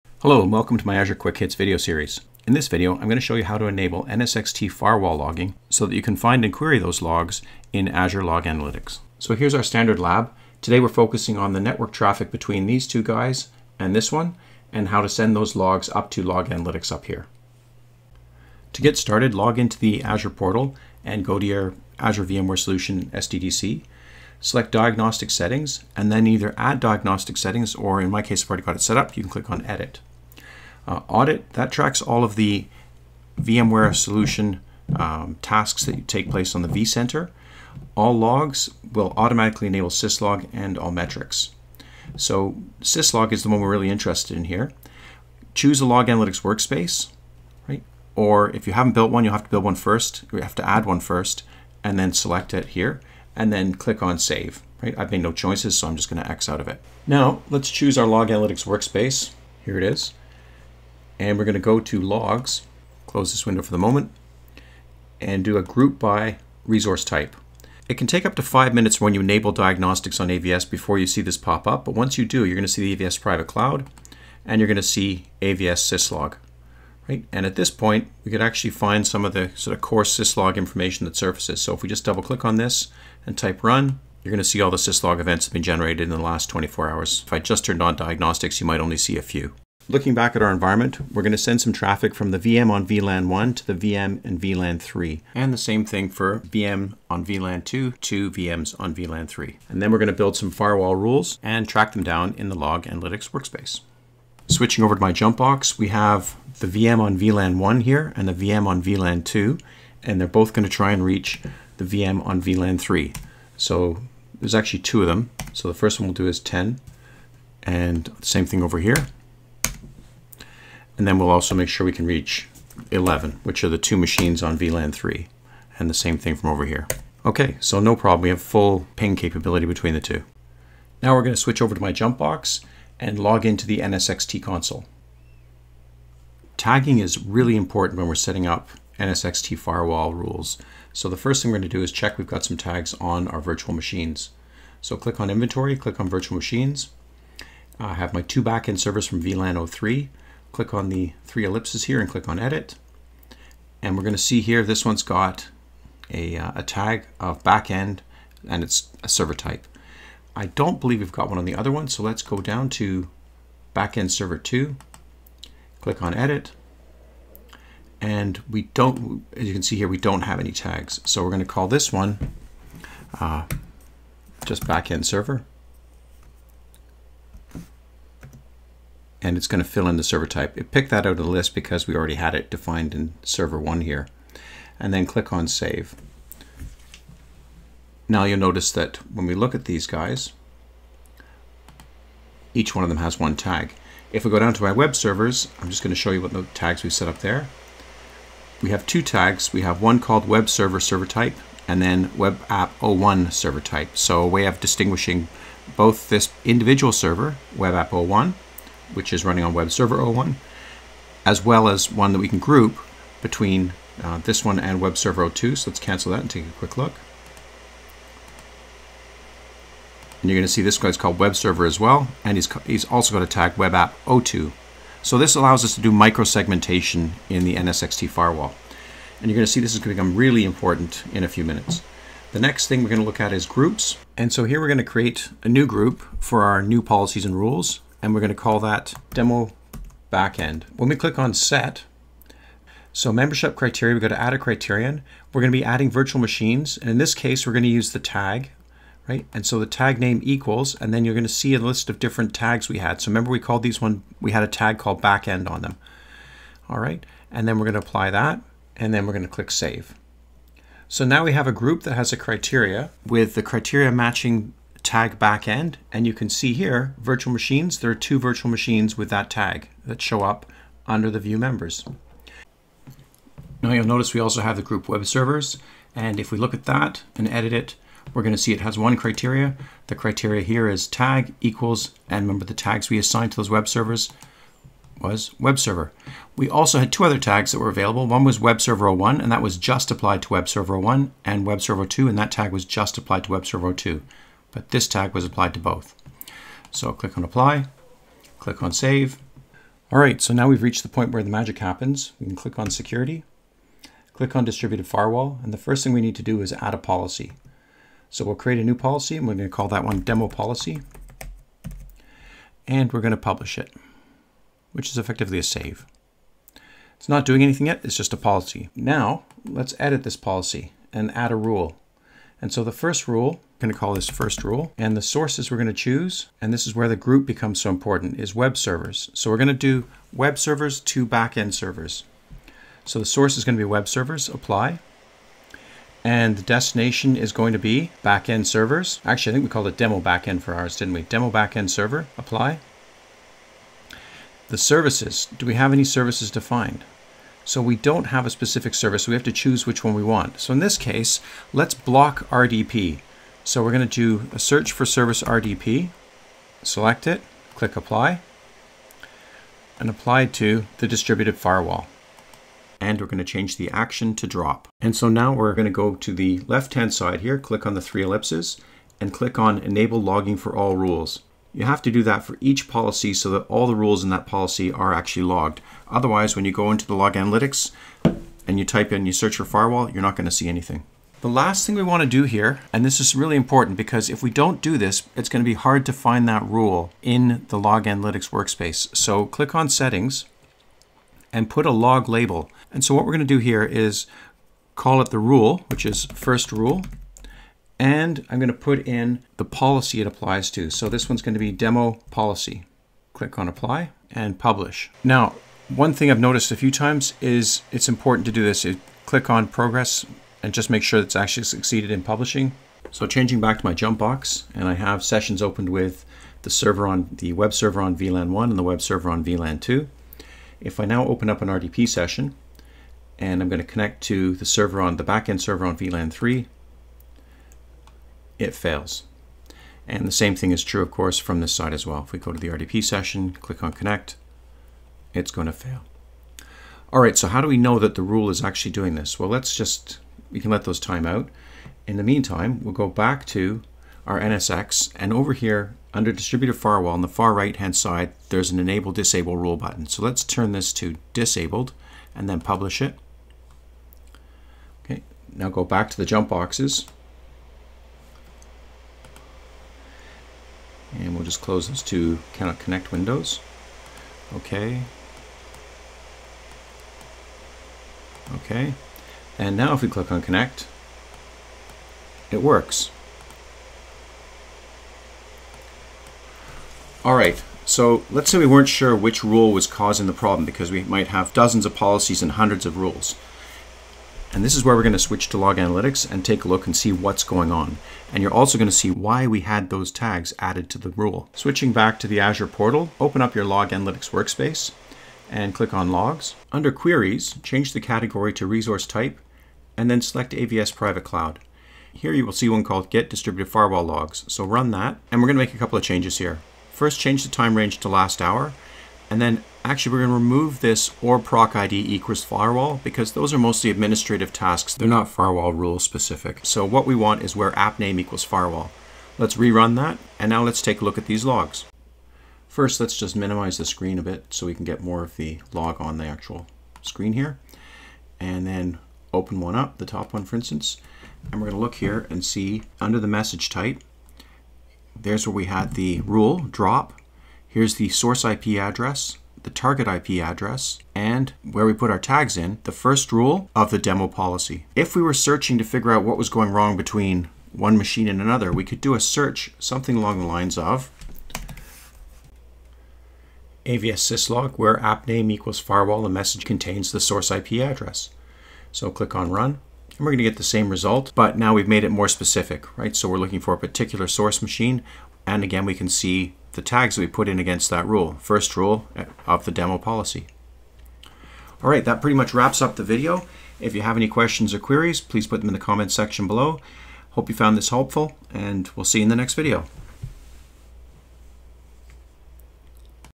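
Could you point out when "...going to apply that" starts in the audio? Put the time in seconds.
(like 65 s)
257 s.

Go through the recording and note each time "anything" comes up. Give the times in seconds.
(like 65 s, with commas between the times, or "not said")
317 s, 380 s.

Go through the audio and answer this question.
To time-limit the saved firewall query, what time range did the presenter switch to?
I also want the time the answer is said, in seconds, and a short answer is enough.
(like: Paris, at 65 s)
last hour, at 507 s.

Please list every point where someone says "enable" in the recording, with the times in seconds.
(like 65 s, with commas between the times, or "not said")
3 s, 39 s, 69 s, 369 s, 448 s.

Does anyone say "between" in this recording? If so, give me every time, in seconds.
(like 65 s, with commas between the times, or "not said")
12 s, 129 s, 213 s, 546 s.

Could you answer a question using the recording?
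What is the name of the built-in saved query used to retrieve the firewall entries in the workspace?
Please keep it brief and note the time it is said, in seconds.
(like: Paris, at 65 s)
Get Distributed Firewall Logs, at 502 s.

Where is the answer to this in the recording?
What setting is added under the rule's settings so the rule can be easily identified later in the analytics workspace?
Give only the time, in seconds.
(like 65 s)
391 s.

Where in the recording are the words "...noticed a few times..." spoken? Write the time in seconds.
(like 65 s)
406 s.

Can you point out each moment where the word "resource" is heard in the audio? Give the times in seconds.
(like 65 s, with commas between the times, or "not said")
66 s, 498 s.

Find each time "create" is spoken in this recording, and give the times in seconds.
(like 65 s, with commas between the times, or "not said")
234 s, 308 s.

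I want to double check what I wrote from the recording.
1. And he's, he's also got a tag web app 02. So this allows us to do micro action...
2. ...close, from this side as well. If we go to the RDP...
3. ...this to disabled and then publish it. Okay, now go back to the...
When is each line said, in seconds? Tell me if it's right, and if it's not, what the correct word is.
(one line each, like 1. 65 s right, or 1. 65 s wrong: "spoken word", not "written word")
1. 222 s wrong: "segmentation", not "action"
2. 430 s wrong: "course", not "close"
3. 450 s right.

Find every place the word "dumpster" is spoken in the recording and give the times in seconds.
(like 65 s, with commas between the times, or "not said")
not said.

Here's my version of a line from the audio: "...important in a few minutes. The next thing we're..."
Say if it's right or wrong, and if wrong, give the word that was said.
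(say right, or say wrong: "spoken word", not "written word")
right.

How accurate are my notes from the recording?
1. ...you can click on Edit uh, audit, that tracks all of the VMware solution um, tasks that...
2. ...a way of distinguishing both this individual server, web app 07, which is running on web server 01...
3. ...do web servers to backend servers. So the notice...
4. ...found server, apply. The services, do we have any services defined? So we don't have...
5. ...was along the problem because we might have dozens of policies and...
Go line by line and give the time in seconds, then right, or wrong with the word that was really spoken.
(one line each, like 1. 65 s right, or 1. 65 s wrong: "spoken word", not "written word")
1. 29 s right
2. 204 s wrong: "01", not "07"
3. 329 s wrong: "source", not "notice"
4. 341 s wrong: "backend", not "found"
5. 479 s wrong: "causing", not "along".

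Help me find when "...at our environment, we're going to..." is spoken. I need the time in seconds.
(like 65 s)
90 s.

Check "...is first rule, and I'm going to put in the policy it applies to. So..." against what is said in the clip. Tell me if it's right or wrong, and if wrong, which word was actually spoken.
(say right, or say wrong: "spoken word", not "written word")
right.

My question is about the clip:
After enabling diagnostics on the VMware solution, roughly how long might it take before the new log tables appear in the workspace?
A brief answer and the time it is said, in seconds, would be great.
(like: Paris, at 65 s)
5 minutes, at 68 s.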